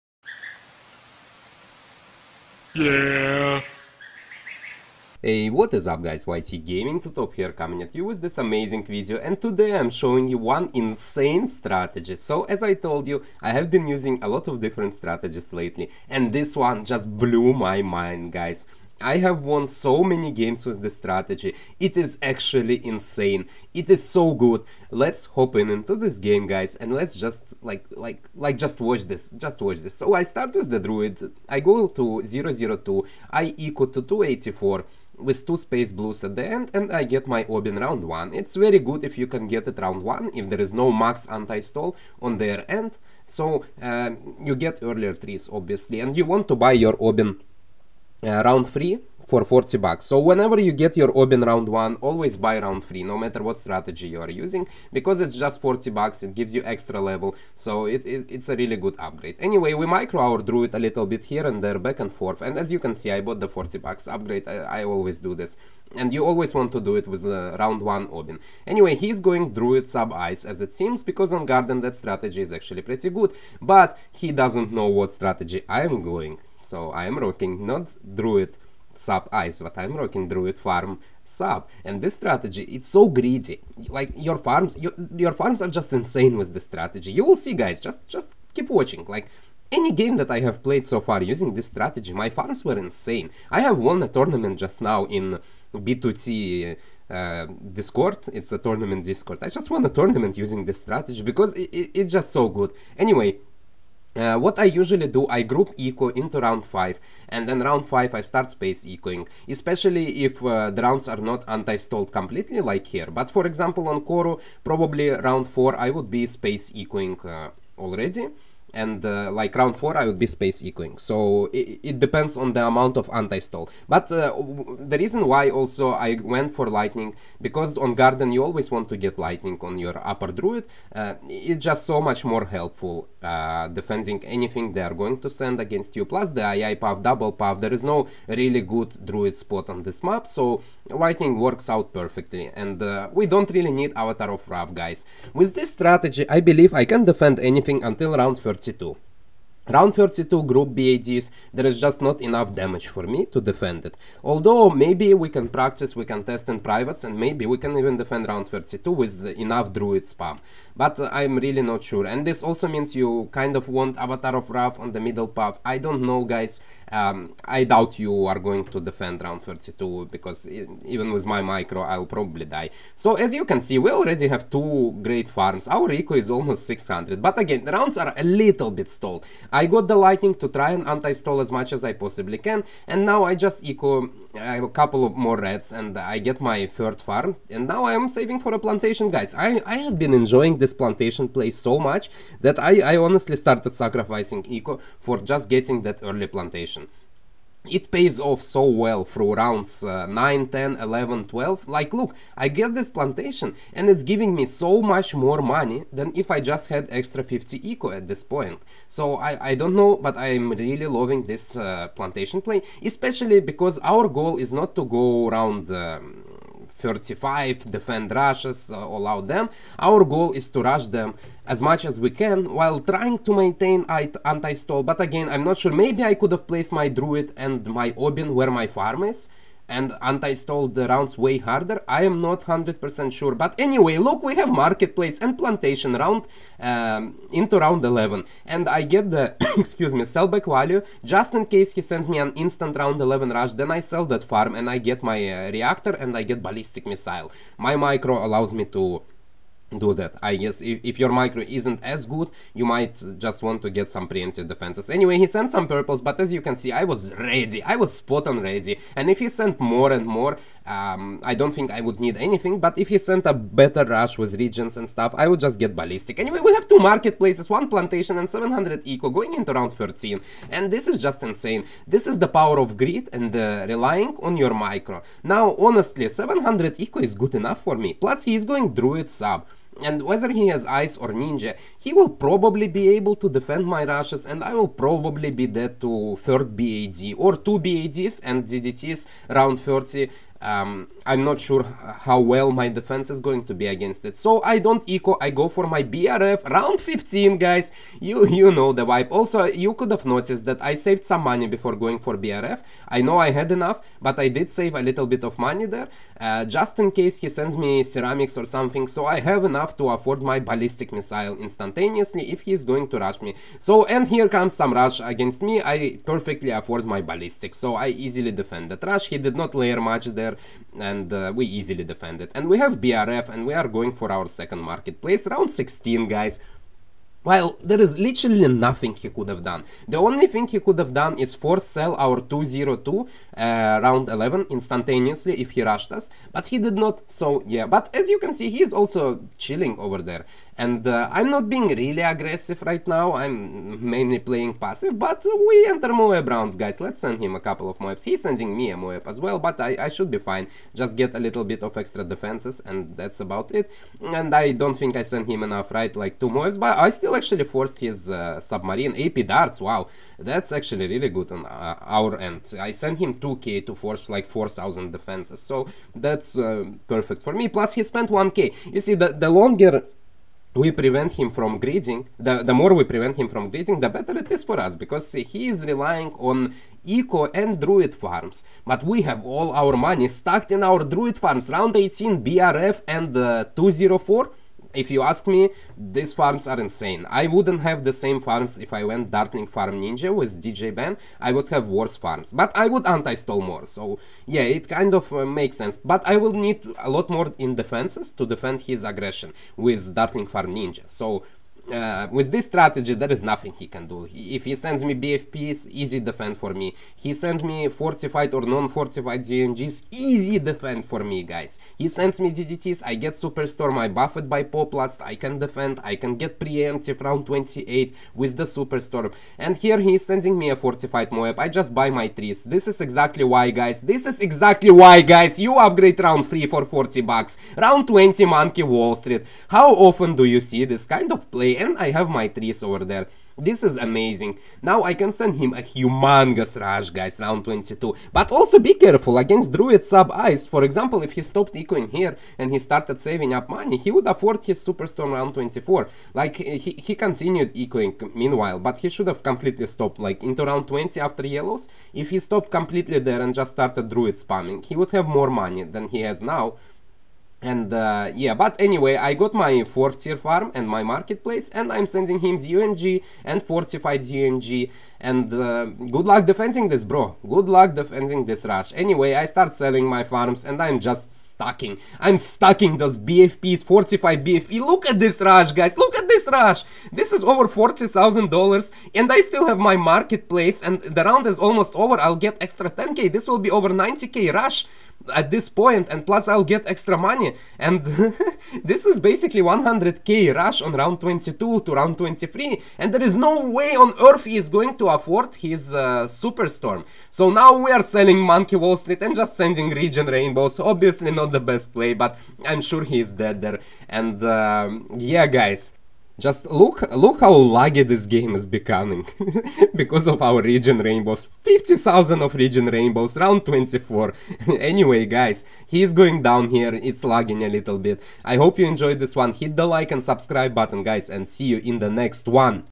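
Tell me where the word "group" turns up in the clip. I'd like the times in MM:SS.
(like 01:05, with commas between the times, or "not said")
01:45, 02:30.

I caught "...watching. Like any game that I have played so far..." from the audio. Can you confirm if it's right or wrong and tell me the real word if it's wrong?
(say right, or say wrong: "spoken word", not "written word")
right.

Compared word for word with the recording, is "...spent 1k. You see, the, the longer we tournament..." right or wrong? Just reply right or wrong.
wrong.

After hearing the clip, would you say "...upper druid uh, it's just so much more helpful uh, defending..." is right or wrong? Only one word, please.
right.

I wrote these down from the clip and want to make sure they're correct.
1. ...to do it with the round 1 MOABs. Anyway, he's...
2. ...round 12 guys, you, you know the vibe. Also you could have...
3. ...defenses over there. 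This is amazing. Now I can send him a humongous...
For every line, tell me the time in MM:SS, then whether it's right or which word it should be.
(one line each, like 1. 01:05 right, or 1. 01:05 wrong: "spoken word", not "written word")
1. 01:06 wrong: "Obyn", not "MOABs"
2. 04:56 wrong: "15", not "12"
3. 07:12 wrong: "trees", not "defenses".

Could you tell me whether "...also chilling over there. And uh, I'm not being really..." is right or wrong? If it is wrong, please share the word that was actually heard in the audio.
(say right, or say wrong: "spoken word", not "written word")
right.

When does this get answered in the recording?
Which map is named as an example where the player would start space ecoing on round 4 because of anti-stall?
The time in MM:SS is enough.
01:54.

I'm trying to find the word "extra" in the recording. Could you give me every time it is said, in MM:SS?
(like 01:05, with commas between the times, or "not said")
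00:56, 03:26, 05:51, 08:02, 08:06.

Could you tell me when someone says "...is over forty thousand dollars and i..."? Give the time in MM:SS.
07:57.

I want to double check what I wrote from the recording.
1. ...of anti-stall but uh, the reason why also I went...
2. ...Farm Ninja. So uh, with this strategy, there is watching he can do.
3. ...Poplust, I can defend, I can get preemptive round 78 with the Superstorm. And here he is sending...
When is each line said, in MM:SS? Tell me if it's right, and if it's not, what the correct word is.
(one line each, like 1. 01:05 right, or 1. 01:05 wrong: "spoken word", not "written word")
1. 02:02 right
2. 06:40 wrong: "nothing", not "watching"
3. 06:54 wrong: "28", not "78".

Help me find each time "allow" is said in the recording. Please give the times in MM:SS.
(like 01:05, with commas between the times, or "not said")
03:38, 04:08.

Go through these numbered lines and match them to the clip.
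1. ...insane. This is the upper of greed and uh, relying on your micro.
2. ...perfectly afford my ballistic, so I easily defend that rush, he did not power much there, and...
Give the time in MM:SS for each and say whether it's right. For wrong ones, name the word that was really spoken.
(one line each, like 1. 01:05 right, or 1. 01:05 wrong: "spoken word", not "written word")
1. 04:31 wrong: "power", not "upper"
2. 05:16 wrong: "layer", not "power".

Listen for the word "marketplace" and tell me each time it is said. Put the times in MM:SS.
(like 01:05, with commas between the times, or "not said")
03:54, 04:26, 05:24, 07:40, 07:59.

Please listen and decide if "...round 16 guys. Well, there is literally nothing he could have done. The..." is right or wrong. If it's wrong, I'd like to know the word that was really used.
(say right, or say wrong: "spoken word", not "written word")
right.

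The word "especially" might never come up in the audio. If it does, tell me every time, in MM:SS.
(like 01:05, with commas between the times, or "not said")
01:49, 03:32.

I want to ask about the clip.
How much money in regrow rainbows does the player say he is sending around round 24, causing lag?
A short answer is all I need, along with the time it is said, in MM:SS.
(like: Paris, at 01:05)
50,000, at 08:31.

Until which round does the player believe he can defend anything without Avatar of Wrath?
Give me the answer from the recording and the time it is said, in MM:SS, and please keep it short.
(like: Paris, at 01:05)
round 30, at 02:27.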